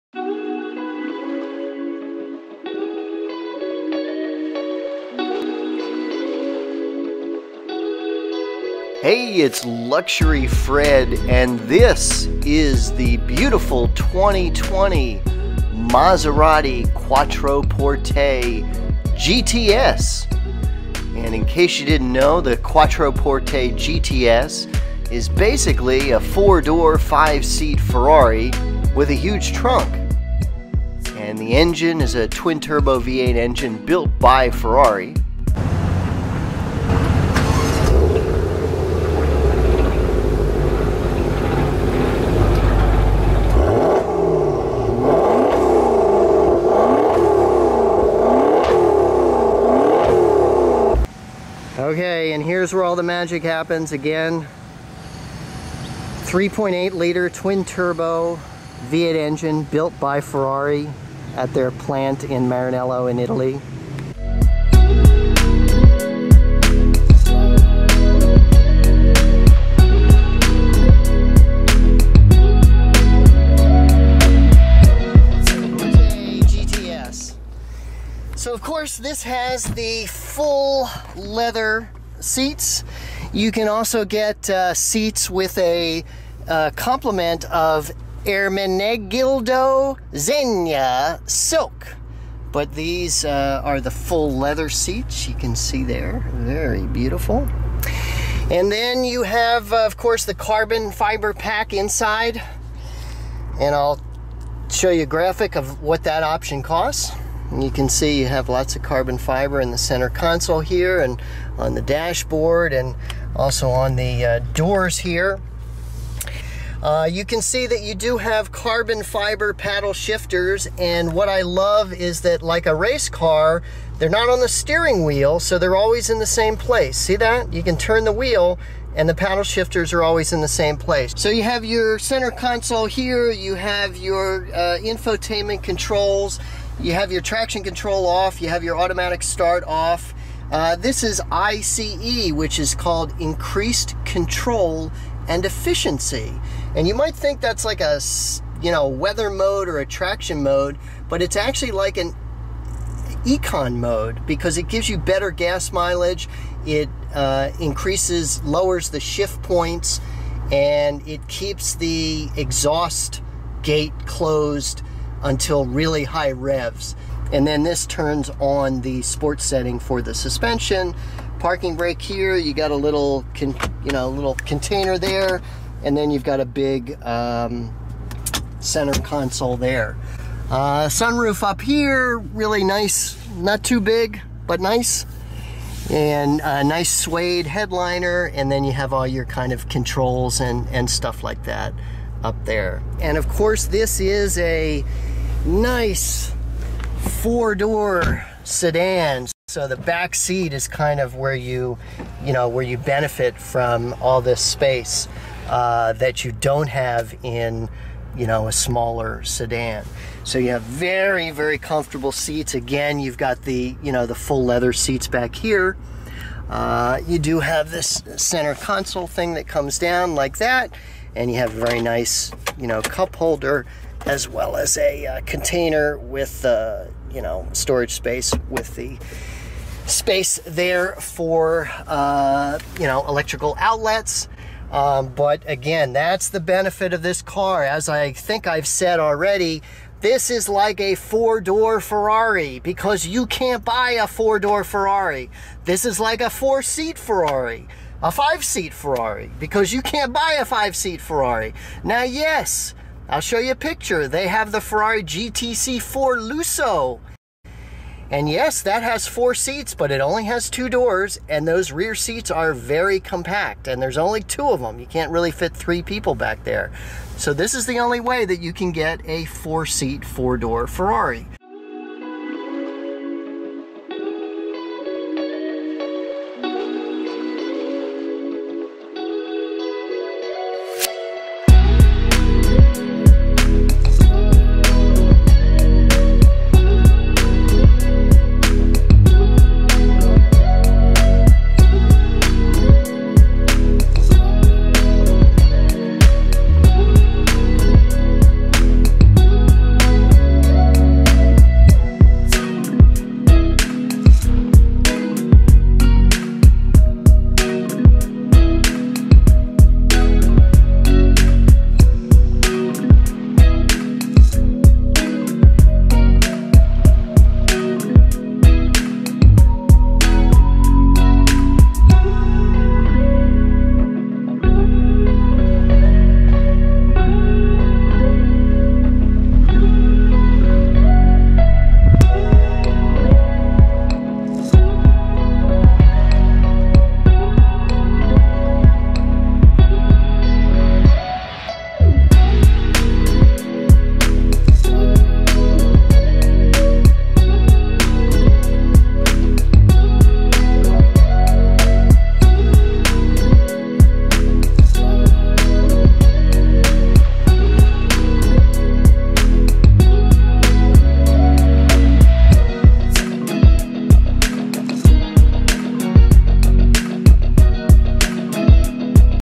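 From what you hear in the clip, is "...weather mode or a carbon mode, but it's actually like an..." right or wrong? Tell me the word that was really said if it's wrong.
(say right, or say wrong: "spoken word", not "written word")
wrong: "traction", not "carbon".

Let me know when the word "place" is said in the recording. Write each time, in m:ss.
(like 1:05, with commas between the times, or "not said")
2:06, 2:10.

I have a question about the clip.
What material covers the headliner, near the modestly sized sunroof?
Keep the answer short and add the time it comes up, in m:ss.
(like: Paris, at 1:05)
suede, at 3:06.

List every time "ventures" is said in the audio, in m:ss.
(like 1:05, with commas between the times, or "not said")
not said.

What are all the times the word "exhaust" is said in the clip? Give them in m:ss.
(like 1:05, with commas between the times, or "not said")
2:42.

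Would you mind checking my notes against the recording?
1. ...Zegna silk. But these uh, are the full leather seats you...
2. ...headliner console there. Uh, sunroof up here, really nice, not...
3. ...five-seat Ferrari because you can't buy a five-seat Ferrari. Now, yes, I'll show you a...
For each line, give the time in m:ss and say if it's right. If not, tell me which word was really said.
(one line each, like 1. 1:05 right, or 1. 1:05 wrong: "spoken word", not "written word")
1. 1:30 right
2. 2:58 wrong: "center", not "headliner"
3. 4:08 right.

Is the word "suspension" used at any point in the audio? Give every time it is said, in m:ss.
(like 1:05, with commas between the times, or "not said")
2:50.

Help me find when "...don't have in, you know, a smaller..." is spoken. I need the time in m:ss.
3:26.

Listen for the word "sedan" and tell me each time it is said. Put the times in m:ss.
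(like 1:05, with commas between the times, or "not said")
3:18, 3:29.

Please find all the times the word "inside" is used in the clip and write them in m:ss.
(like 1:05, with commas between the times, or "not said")
1:41.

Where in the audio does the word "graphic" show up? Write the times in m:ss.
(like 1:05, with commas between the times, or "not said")
1:45.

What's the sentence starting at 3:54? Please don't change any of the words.
Um, but again, that's the benefit of this car.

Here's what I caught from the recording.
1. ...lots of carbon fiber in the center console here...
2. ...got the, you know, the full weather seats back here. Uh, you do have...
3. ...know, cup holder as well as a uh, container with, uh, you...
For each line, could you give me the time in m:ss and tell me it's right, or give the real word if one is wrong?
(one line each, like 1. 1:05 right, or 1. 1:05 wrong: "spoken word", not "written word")
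1. 1:48 right
2. 3:33 wrong: "leather", not "weather"
3. 3:42 right.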